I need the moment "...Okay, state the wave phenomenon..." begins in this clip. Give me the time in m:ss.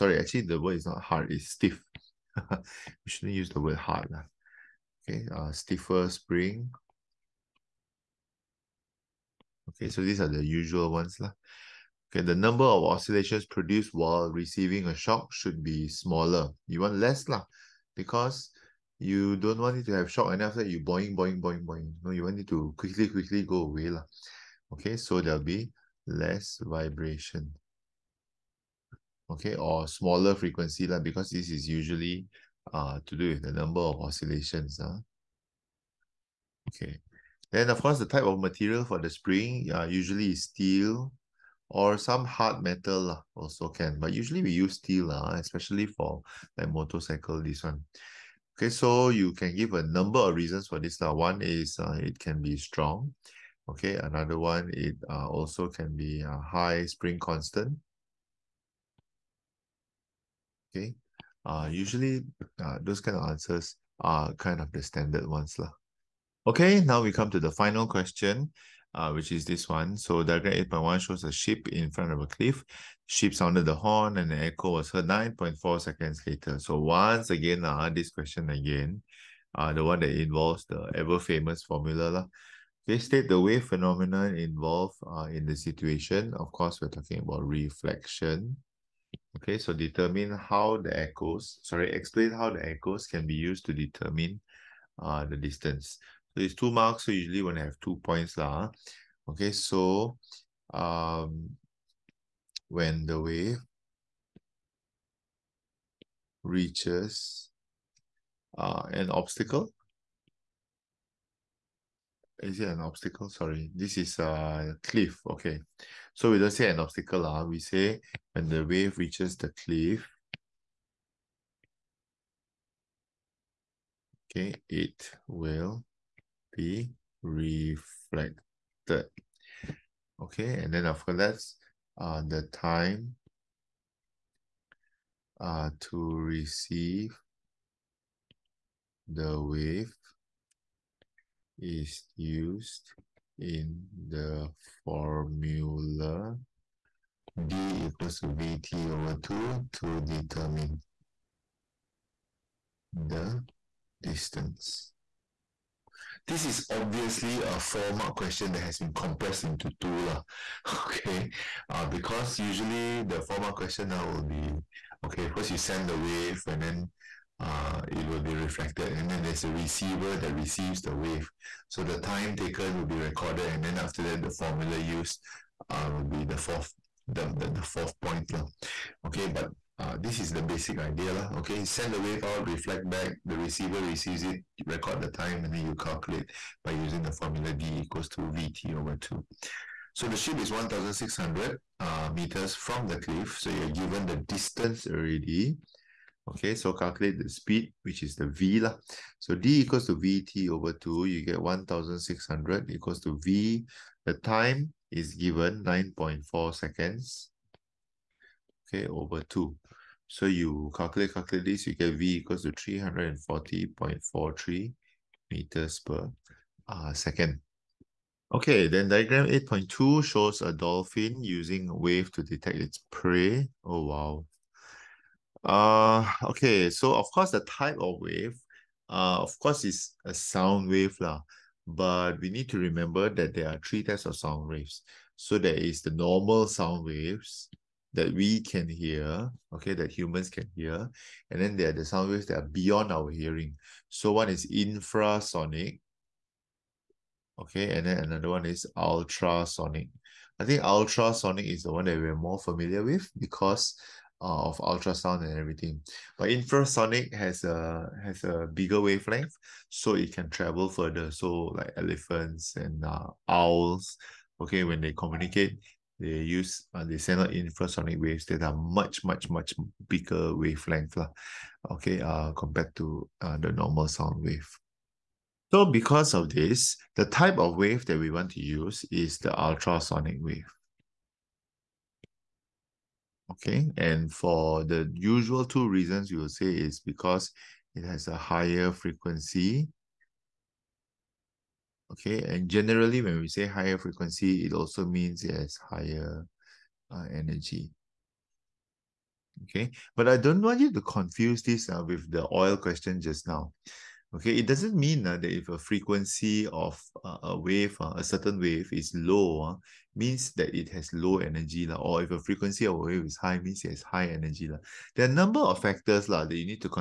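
1:22.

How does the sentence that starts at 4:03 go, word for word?
So one is infrasonic, okay, and then another one is ultrasonic.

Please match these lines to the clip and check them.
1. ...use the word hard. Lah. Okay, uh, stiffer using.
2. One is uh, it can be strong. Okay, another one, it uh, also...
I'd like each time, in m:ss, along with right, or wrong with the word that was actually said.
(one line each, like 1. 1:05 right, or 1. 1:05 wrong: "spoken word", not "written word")
1. 0:03 wrong: "spring", not "using"
2. 0:51 right.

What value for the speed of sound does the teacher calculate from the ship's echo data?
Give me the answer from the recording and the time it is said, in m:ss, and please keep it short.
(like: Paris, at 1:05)
340.43 m/s, at 3:32.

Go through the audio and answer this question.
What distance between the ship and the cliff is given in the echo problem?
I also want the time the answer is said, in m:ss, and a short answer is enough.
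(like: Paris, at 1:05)
1,600 meters, at 3:10.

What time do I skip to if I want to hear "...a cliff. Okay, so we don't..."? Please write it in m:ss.
1:54.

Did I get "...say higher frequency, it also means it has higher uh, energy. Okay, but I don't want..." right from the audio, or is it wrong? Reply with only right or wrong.
right.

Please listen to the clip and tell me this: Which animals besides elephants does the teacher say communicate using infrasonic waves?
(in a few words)
owls.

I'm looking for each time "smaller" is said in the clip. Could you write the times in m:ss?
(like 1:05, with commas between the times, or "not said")
0:15, 0:29.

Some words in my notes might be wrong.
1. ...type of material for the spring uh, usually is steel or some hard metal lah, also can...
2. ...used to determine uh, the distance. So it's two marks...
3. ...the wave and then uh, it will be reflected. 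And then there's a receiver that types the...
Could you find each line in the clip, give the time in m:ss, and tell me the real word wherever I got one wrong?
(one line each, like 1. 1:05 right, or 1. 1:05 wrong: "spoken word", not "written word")
1. 0:38 right
2. 1:33 right
3. 2:45 wrong: "receives", not "types".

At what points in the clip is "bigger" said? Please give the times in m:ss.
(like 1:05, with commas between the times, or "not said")
4:18, 4:29.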